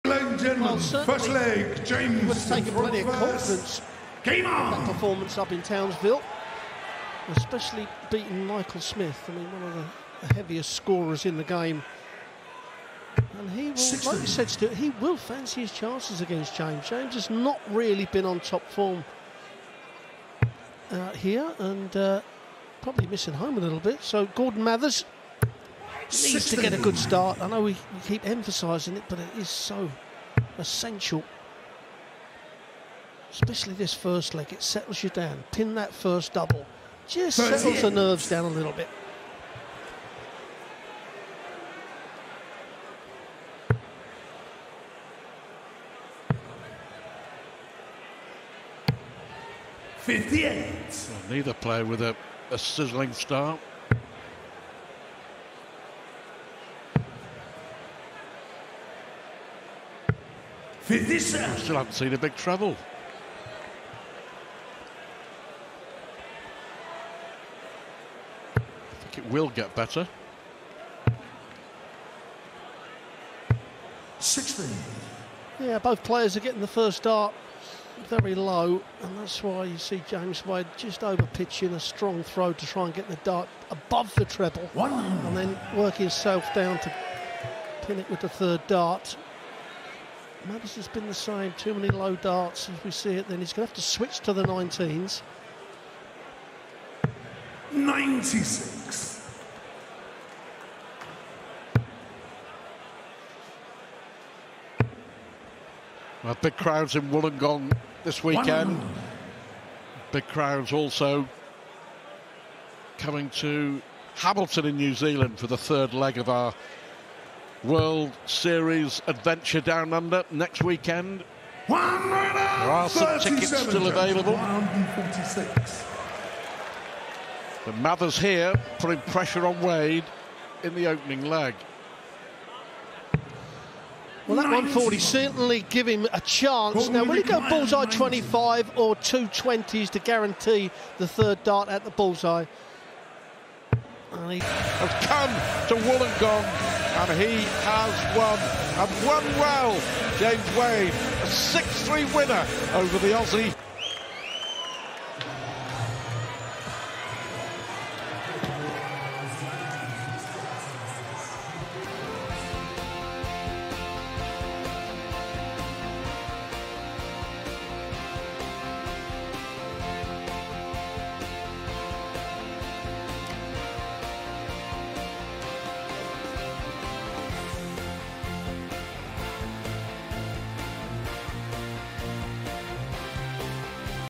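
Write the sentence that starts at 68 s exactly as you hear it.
I think it will get better.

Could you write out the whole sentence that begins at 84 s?
and then work himself down to pin it with the third dart.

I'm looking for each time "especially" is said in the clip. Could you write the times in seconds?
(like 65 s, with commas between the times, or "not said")
7 s, 33 s.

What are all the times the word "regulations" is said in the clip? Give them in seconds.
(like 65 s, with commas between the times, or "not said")
not said.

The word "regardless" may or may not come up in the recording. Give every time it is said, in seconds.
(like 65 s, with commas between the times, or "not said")
not said.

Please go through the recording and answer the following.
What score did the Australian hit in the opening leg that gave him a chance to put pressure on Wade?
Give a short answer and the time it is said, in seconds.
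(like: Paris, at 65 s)
140, at 134 s.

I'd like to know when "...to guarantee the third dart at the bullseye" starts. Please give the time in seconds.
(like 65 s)
139 s.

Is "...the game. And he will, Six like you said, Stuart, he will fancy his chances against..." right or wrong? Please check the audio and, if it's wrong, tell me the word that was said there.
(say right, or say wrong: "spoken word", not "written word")
right.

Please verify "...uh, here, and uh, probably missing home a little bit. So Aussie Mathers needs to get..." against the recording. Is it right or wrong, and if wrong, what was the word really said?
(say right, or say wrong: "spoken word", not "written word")
wrong: "Gordon", not "Aussie".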